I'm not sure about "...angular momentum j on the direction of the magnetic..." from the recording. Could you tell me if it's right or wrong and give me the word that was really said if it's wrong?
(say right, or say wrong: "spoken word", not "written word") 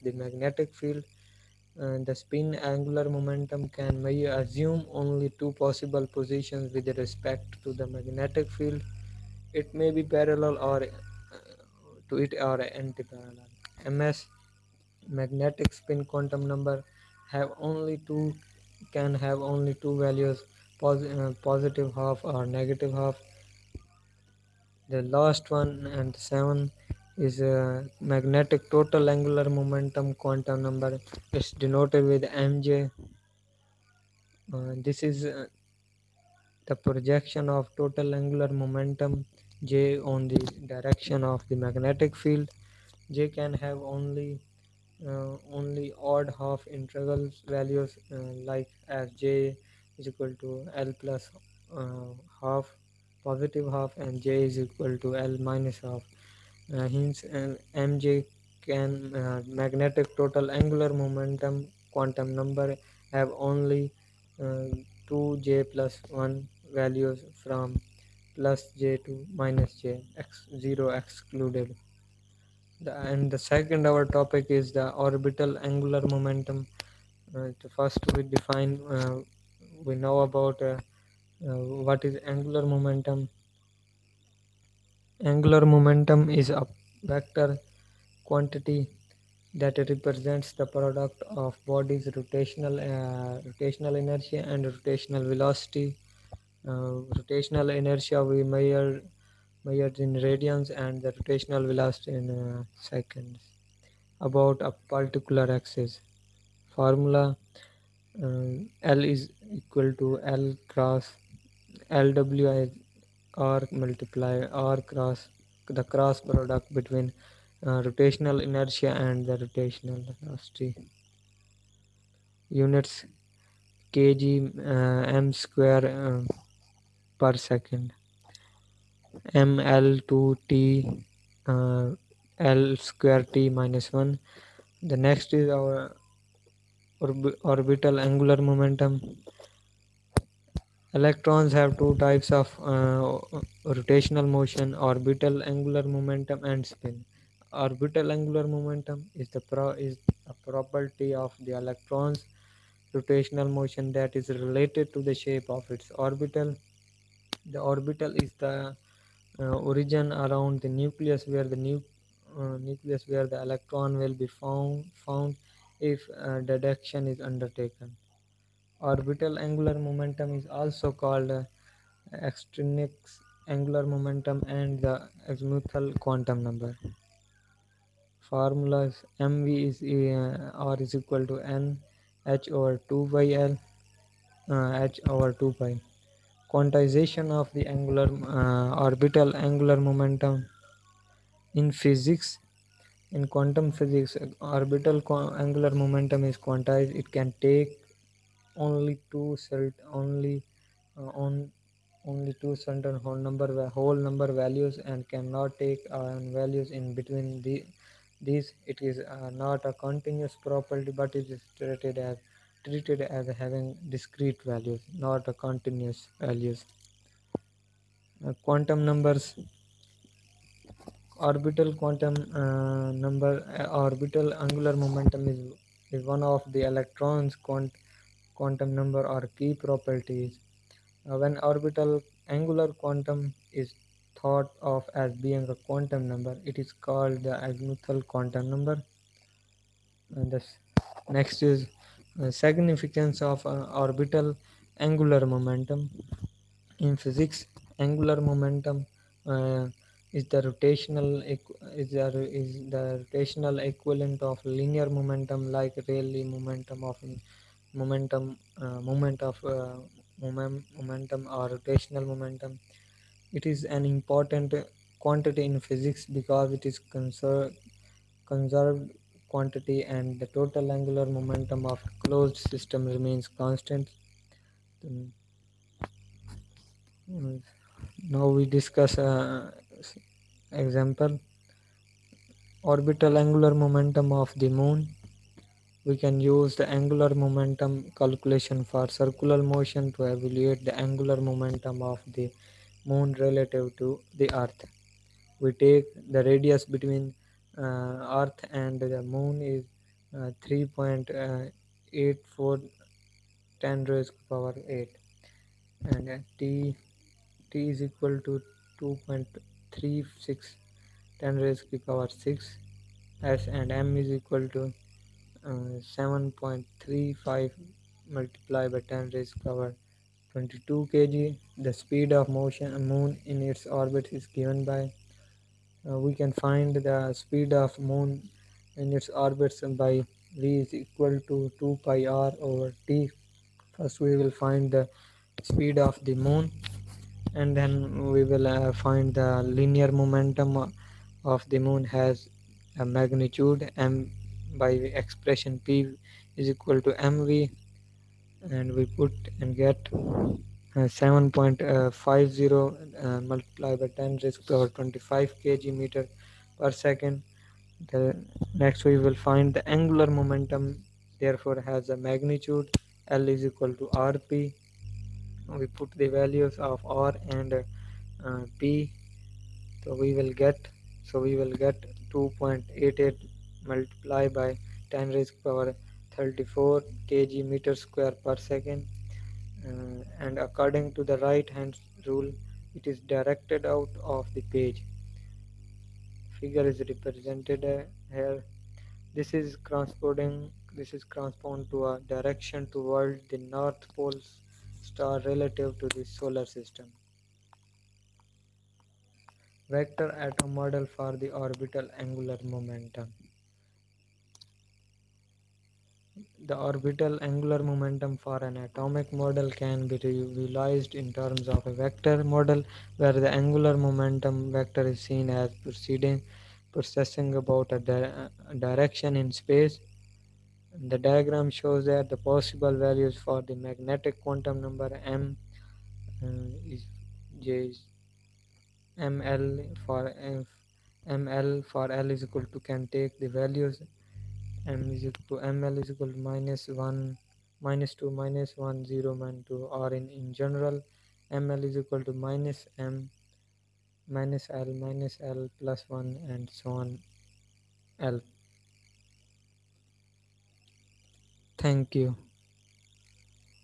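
right.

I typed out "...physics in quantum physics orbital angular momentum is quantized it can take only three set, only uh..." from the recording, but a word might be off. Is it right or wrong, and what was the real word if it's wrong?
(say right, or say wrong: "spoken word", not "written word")
wrong: "two", not "three".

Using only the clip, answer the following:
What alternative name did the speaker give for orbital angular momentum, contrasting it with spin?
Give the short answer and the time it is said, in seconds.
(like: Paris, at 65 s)
Extrinsic angular momentum, at 172 s.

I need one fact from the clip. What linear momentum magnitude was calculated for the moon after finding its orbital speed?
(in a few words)
7.50 x 10^25 kg m/s.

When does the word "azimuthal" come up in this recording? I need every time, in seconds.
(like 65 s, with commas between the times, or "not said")
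175 s, 237 s.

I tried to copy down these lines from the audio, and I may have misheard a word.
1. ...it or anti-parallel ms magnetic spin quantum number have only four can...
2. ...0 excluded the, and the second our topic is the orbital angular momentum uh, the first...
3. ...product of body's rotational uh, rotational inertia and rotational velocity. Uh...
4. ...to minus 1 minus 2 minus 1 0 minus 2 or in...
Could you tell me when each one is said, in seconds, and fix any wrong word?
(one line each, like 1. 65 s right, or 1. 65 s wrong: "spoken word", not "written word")
1. 12 s wrong: "two", not "four"
2. 70 s right
3. 90 s right
4. 436 s right.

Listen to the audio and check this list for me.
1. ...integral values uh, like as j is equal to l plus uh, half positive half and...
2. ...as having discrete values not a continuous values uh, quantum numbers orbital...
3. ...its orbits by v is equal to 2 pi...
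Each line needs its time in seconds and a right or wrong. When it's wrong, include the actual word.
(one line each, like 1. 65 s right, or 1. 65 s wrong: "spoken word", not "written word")
1. 46 s right
2. 213 s right
3. 328 s right.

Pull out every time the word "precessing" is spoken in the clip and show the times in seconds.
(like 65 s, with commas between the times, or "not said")
416 s.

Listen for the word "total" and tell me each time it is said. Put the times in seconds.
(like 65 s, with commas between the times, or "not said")
28 s, 37 s, 60 s, 270 s.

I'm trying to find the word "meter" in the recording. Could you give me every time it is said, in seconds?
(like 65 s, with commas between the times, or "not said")
355 s, 377 s.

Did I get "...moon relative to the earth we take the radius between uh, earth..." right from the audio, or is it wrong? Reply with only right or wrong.
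right.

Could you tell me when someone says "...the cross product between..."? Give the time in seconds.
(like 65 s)
115 s.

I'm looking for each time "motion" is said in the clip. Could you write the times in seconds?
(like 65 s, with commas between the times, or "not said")
144 s, 153 s, 289 s, 322 s.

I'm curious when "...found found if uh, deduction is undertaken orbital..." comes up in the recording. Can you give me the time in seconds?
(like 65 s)
164 s.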